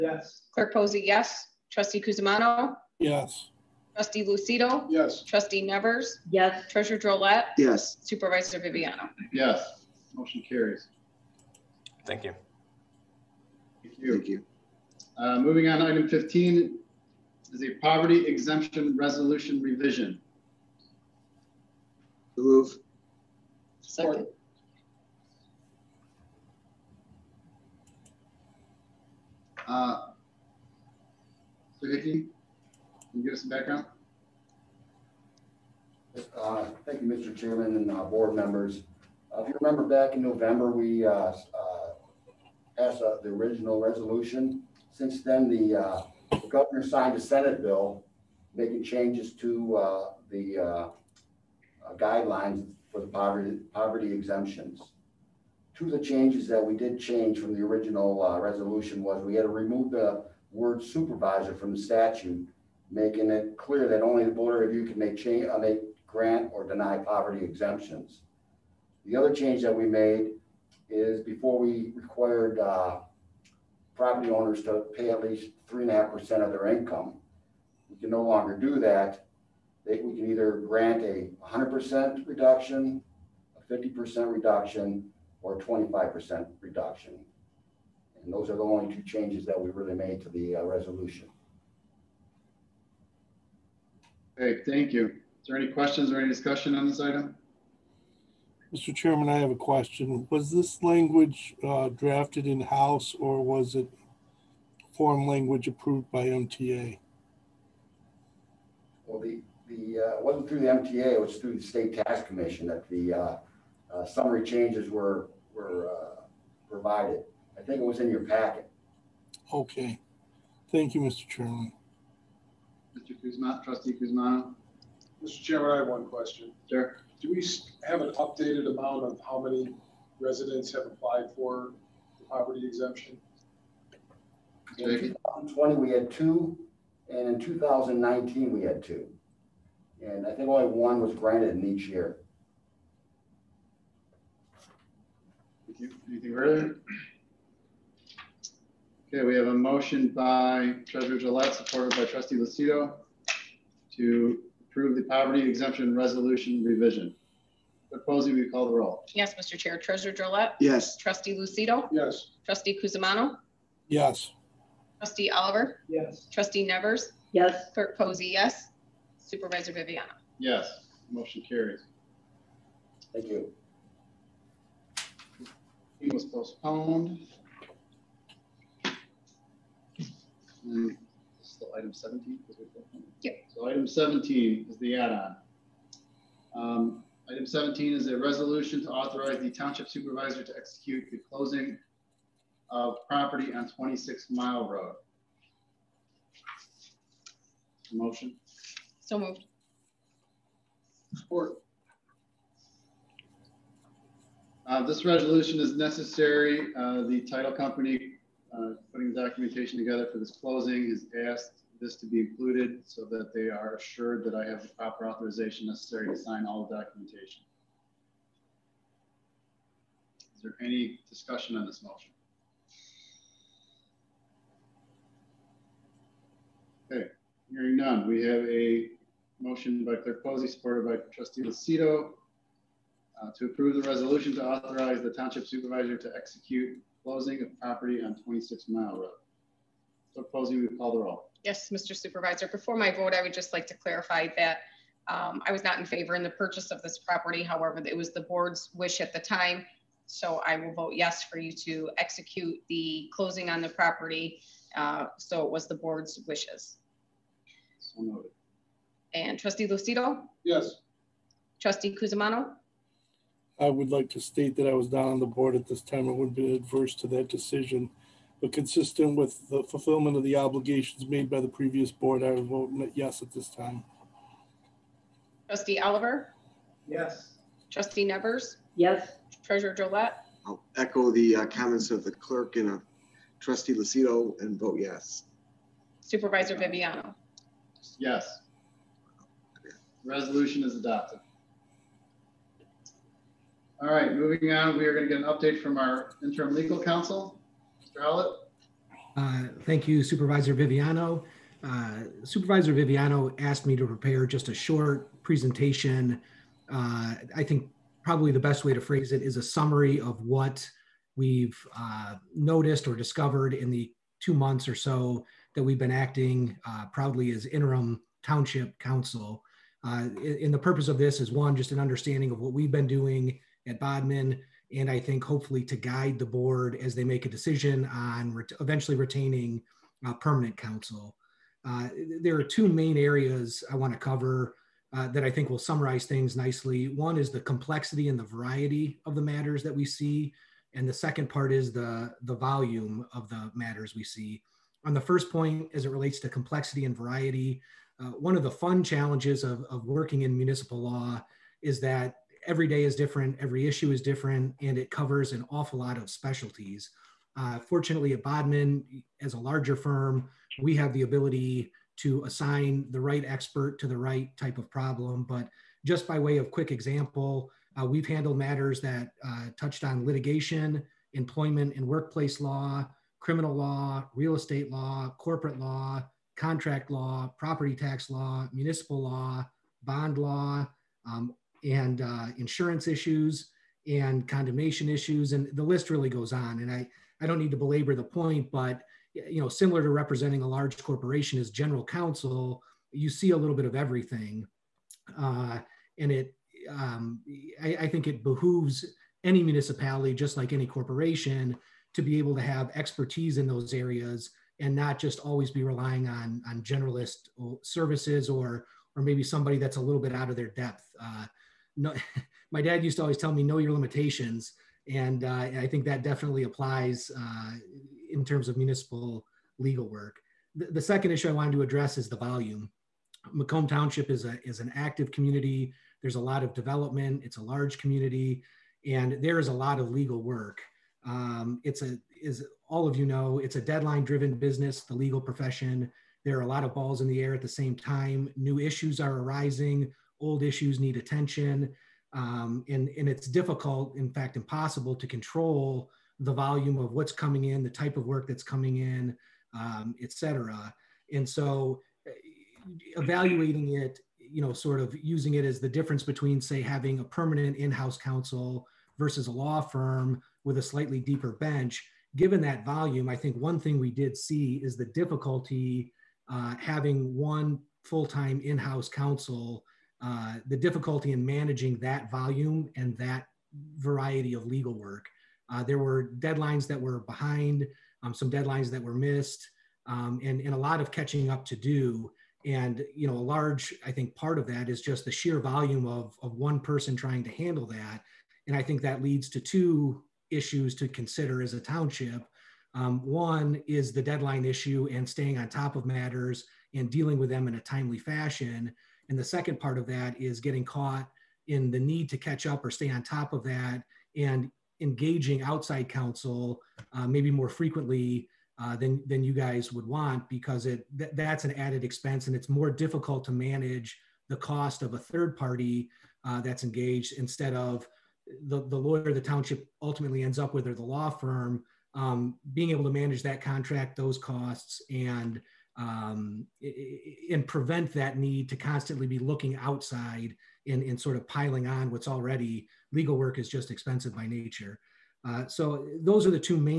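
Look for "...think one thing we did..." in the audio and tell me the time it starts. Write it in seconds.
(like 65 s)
463 s.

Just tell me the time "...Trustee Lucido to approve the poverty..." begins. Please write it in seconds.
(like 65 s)
152 s.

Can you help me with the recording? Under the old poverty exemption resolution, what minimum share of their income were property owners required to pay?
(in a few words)
3.5%.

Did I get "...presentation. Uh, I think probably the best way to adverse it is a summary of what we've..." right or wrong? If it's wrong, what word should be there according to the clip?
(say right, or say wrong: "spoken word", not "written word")
wrong: "phrase", not "adverse".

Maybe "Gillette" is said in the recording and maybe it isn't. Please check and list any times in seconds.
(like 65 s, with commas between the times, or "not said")
151 s, 279 s.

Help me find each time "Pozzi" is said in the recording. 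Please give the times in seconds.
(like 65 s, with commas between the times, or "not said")
0 s, 158 s, 167 s, 230 s, 240 s.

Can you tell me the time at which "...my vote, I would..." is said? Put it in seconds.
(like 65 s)
242 s.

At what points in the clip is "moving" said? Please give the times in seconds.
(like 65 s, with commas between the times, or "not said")
15 s, 294 s.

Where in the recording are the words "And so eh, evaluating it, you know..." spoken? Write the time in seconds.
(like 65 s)
451 s.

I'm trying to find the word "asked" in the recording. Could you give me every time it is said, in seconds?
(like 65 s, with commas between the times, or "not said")
211 s, 303 s.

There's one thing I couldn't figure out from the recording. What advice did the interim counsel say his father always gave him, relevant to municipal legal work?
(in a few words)
know your limitations.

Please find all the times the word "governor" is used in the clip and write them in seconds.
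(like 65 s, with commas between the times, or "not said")
46 s.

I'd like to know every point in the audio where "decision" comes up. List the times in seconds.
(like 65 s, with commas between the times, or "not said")
267 s, 327 s.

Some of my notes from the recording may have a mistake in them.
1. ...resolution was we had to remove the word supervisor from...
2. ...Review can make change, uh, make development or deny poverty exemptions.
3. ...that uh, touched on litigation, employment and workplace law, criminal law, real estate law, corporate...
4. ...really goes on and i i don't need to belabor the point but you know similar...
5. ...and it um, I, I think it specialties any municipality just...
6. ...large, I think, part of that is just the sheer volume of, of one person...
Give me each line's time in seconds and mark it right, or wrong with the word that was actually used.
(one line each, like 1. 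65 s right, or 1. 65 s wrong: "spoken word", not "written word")
1. 58 s right
2. 64 s wrong: "grant", not "development"
3. 368 s right
4. 385 s right
5. 395 s wrong: "behooves", not "specialties"
6. 483 s right.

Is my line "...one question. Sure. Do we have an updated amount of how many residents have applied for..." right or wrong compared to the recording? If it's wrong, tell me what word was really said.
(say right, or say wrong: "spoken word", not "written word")
right.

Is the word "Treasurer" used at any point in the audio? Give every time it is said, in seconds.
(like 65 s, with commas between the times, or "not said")
6 s, 150 s, 159 s, 279 s.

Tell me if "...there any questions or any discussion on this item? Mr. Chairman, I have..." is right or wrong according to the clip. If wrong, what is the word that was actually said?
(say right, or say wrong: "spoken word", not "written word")
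right.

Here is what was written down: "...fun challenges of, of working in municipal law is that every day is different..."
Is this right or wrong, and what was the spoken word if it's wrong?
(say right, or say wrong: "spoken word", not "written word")
right.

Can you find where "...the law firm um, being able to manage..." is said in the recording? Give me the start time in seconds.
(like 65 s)
520 s.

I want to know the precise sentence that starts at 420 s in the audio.
The, the, second issue I wanted to address is the volume.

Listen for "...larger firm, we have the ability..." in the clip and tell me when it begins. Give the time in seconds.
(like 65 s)
359 s.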